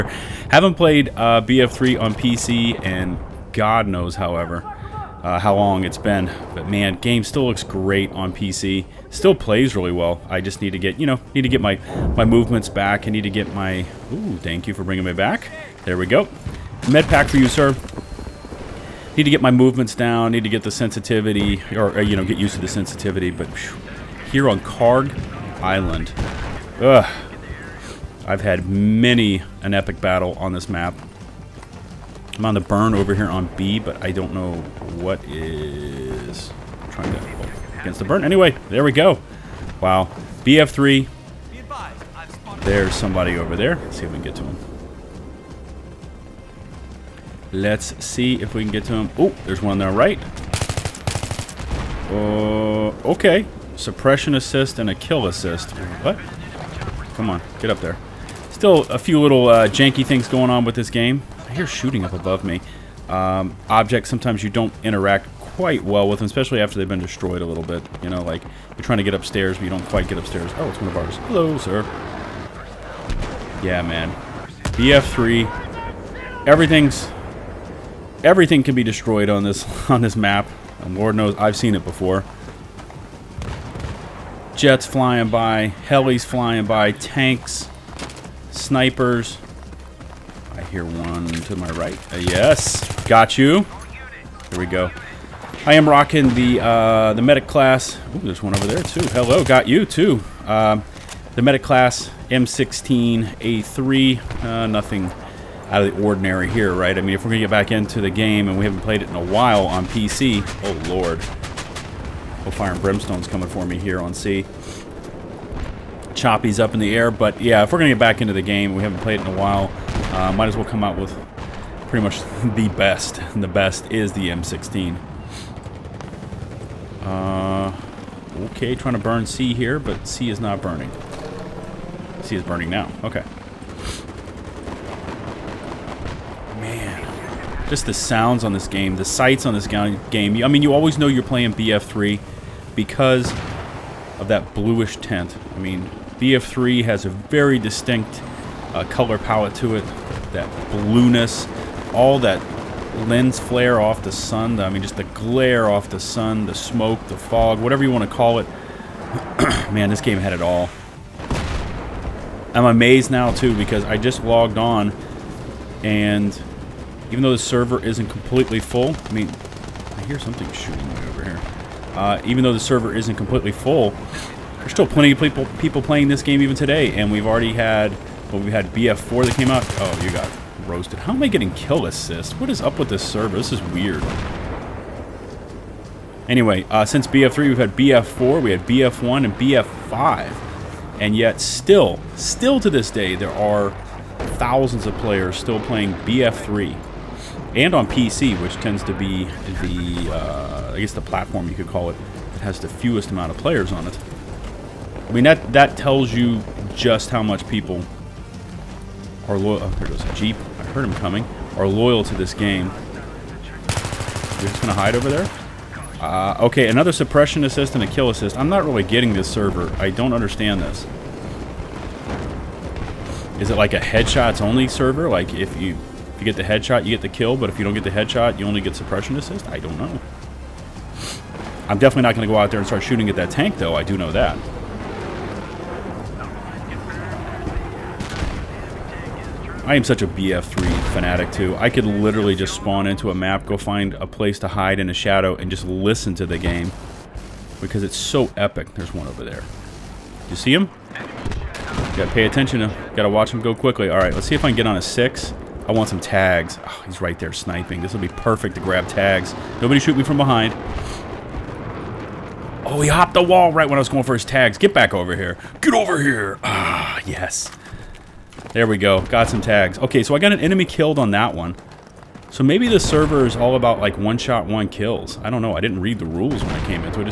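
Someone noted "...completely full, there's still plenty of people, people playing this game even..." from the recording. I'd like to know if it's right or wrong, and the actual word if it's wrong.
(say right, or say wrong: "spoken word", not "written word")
right.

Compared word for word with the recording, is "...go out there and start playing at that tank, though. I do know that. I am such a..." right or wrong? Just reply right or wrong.
wrong.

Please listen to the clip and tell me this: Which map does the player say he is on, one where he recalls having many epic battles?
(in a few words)
Kharg Island.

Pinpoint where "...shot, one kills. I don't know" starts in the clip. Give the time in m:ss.
4:34.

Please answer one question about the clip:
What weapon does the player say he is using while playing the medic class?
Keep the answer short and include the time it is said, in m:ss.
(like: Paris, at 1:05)
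M16A3, at 1:42.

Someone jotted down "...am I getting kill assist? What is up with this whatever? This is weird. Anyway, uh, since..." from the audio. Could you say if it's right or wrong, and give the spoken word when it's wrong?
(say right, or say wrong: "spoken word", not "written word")
wrong: "server", not "whatever".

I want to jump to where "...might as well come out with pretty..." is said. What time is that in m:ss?
2:00.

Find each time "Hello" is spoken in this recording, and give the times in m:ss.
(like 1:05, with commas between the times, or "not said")
1:11, 1:39.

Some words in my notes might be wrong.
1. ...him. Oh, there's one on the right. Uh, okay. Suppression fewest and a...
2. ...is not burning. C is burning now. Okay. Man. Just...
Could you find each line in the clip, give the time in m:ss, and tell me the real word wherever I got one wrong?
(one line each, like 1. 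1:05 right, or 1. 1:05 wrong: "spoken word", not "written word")
1. 0:48 wrong: "assist", not "fewest"
2. 2:10 right.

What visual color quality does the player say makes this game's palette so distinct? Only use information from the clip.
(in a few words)
bluish tint.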